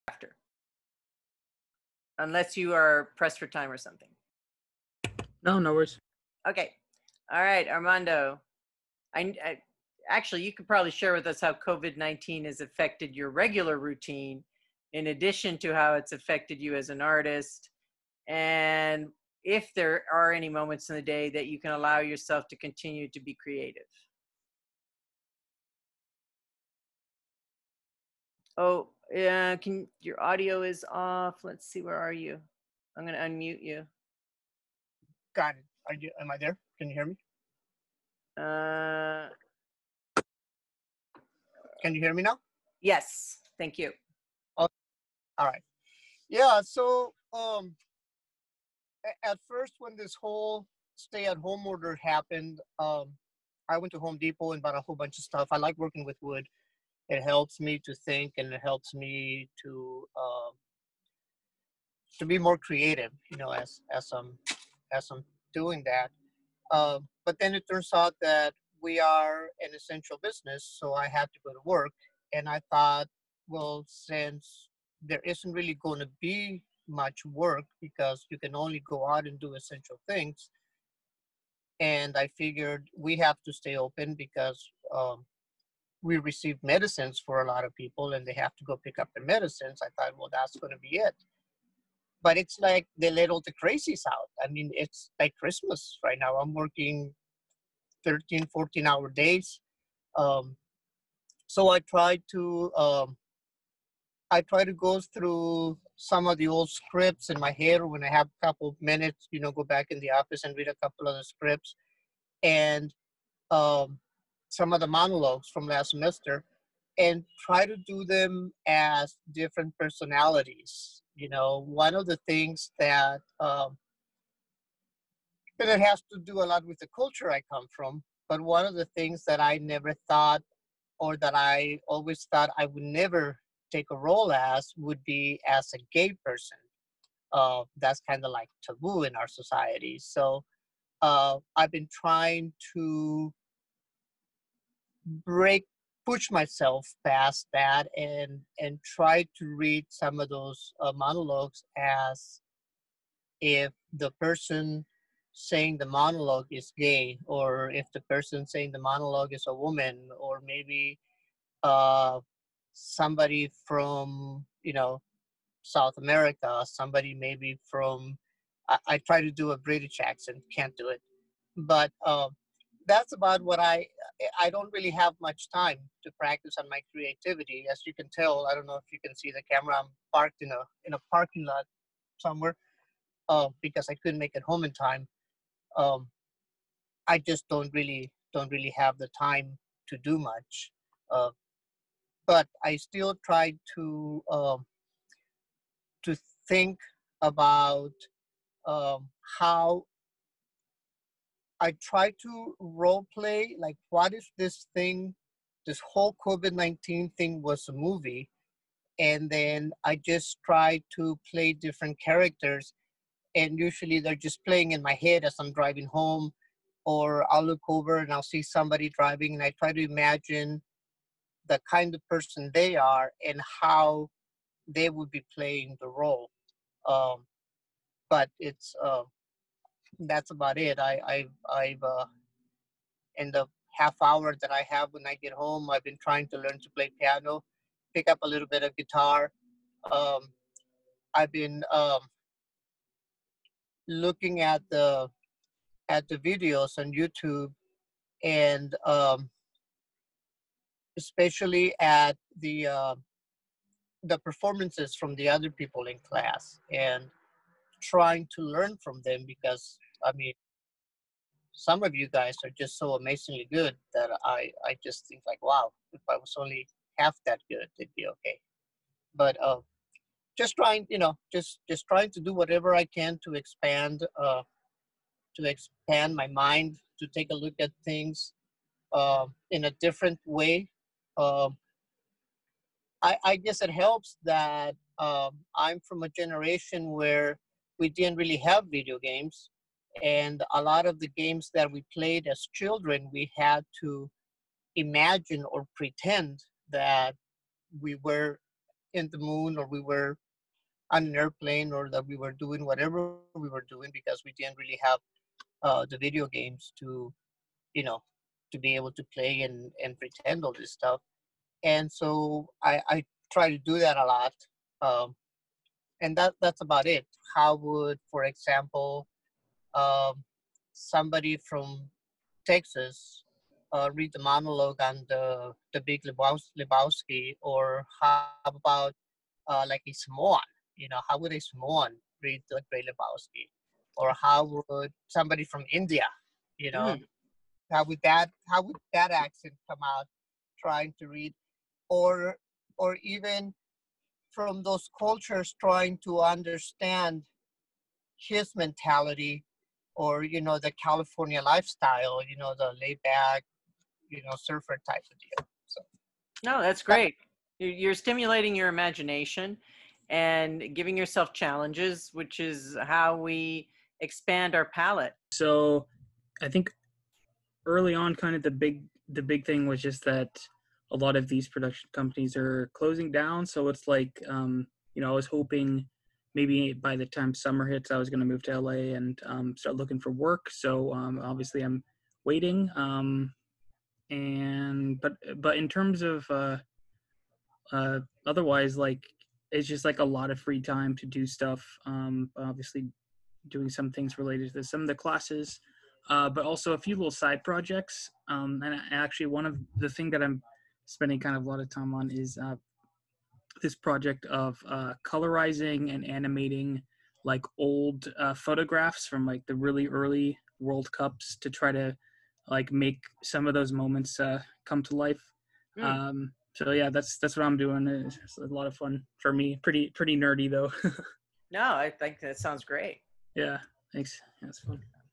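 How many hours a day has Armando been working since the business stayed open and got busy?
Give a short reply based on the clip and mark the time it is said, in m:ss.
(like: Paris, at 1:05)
13, 14, at 1:38.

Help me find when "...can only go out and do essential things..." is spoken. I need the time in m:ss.
1:18.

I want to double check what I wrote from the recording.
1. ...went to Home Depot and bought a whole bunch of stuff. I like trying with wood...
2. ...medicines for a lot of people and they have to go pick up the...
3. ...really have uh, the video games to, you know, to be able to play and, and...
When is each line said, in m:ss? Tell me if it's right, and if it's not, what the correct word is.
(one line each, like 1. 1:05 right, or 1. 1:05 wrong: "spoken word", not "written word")
1. 0:53 wrong: "working", not "trying"
2. 1:26 right
3. 5:04 right.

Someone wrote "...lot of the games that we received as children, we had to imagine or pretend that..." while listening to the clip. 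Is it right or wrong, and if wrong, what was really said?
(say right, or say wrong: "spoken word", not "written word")
wrong: "played", not "received".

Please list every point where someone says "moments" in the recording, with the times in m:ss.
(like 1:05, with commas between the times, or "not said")
0:20, 6:53.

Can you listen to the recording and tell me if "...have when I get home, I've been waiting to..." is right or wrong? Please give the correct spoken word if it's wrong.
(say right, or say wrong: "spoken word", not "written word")
wrong: "trying", not "waiting".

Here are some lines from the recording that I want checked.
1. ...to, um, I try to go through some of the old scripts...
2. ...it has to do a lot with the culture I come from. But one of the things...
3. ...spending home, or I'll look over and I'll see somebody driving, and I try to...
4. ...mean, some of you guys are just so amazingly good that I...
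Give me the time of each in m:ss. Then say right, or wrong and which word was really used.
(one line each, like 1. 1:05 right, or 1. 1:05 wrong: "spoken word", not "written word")
1. 1:42 right
2. 2:05 right
3. 3:35 wrong: "driving", not "spending"
4. 4:20 right.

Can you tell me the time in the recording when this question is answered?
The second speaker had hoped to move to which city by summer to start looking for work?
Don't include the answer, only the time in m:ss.
6:18.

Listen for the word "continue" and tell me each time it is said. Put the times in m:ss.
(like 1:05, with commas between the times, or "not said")
0:22.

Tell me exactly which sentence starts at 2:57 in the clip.
As you can tell, I don't know if you can see the camera.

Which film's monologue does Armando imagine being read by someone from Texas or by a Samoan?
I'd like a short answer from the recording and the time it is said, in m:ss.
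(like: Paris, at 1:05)
The Big Lebowski, at 5:25.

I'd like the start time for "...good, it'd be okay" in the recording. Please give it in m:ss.
4:27.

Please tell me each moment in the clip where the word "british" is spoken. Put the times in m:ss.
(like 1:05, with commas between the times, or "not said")
2:49.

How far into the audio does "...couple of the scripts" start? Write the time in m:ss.
1:50.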